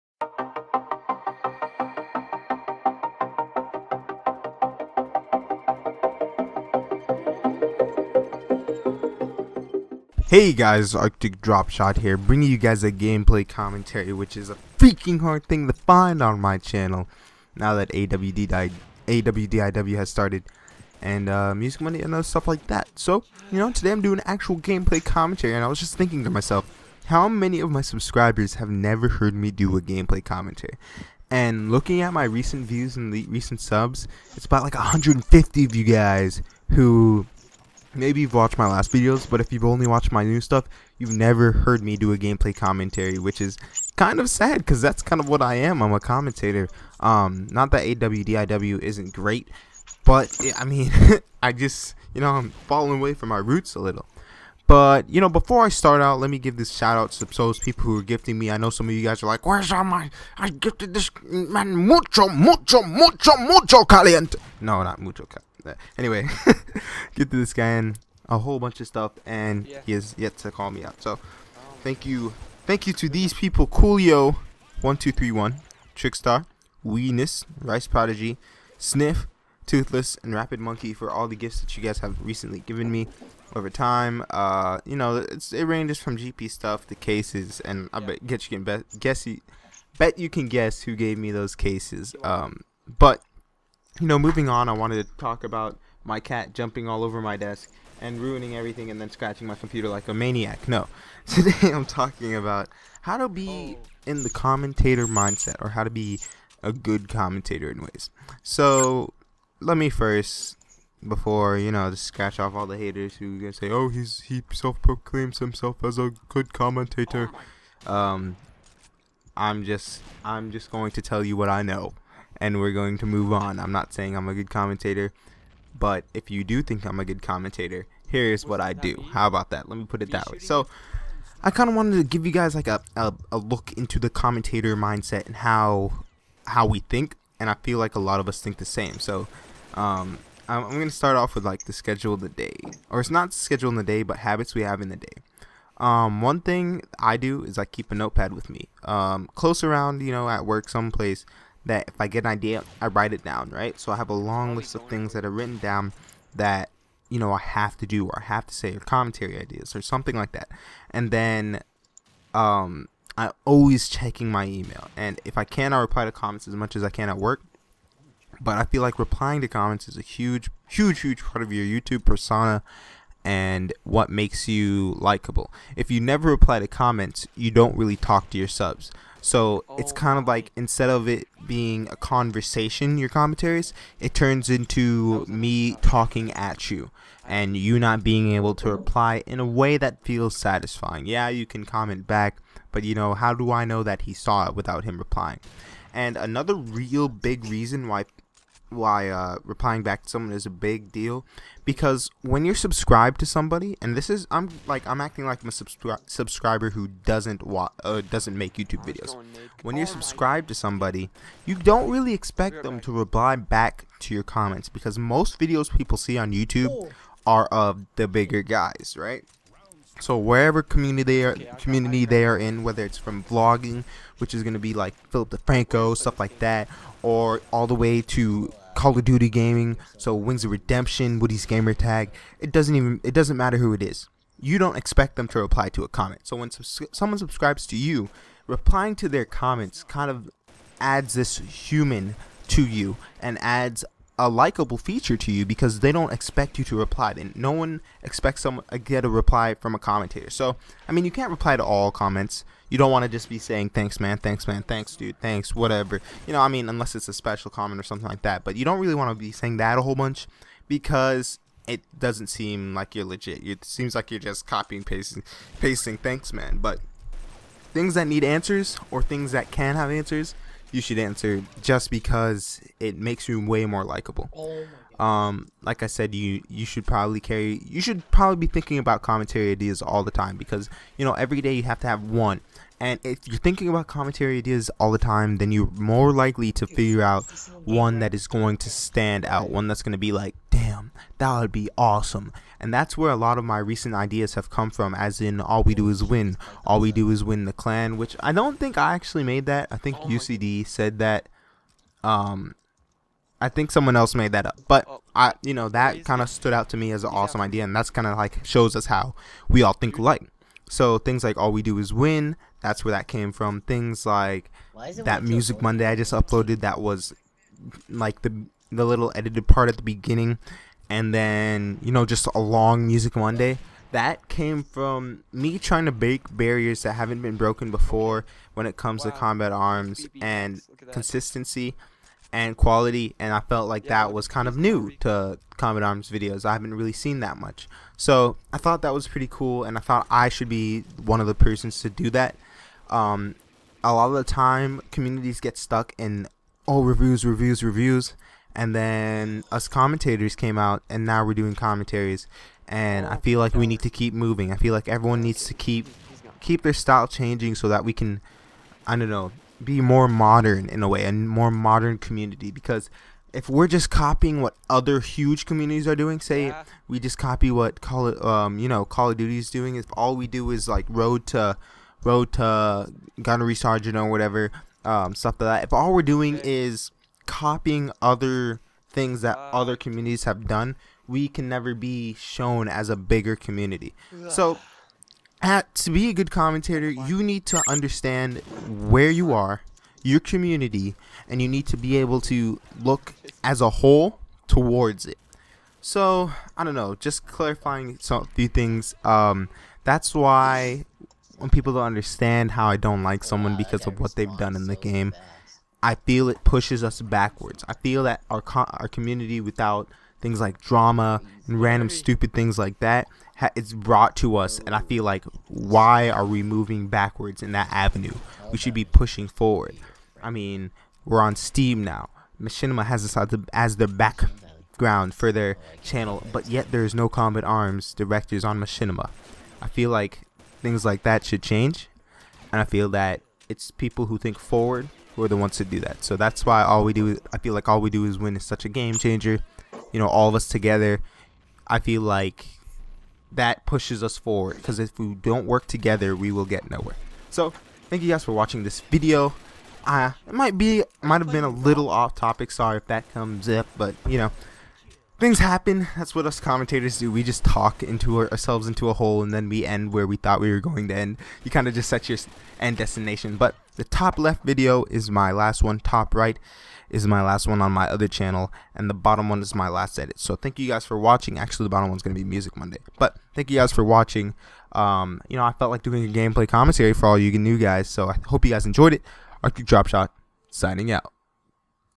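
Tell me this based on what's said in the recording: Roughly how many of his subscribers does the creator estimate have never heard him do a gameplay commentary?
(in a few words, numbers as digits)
150.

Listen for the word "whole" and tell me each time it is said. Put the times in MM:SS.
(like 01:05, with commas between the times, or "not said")
01:08, 04:19, 06:33.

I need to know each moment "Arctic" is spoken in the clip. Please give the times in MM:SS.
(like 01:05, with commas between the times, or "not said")
00:10, 07:59.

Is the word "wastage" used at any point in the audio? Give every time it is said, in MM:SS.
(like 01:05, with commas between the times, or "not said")
not said.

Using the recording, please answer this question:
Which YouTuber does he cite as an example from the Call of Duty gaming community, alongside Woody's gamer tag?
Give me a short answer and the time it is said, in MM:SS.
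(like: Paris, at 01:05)
Wings of Redemption, at 03:50.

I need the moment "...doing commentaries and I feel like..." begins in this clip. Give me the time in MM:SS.
05:51.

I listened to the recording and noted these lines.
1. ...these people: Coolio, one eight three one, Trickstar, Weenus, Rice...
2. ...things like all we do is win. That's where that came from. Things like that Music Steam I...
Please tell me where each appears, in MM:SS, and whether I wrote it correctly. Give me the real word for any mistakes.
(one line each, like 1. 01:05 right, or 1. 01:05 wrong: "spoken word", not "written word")
1. 01:13 wrong: "two", not "eight"
2. 05:10 wrong: "Monday", not "Steam".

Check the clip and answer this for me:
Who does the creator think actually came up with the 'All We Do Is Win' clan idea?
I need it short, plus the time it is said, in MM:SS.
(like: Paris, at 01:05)
UCD, at 05:00.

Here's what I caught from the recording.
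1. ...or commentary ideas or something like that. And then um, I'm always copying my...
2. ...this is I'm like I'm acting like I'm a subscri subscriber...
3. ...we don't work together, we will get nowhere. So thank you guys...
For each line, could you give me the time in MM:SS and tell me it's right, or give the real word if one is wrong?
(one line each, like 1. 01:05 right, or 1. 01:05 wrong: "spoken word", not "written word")
1. 02:38 wrong: "checking", not "copying"
2. 03:23 right
3. 07:24 right.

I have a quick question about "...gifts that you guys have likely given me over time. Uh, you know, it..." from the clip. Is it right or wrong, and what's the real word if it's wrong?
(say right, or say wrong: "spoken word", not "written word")
wrong: "recently", not "likely".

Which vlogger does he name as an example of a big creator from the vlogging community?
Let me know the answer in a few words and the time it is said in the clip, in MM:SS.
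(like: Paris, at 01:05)
Philip DeFranco, at 03:45.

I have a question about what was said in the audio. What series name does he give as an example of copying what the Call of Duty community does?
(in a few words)
Road to Gunnery Sergeant.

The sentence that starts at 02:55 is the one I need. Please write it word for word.
If you never reply to comments, you don't really talk to your subs.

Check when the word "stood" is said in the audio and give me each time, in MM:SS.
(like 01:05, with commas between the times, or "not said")
05:06.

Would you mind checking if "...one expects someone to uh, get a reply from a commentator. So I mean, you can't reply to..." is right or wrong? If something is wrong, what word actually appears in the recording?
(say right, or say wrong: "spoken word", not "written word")
right.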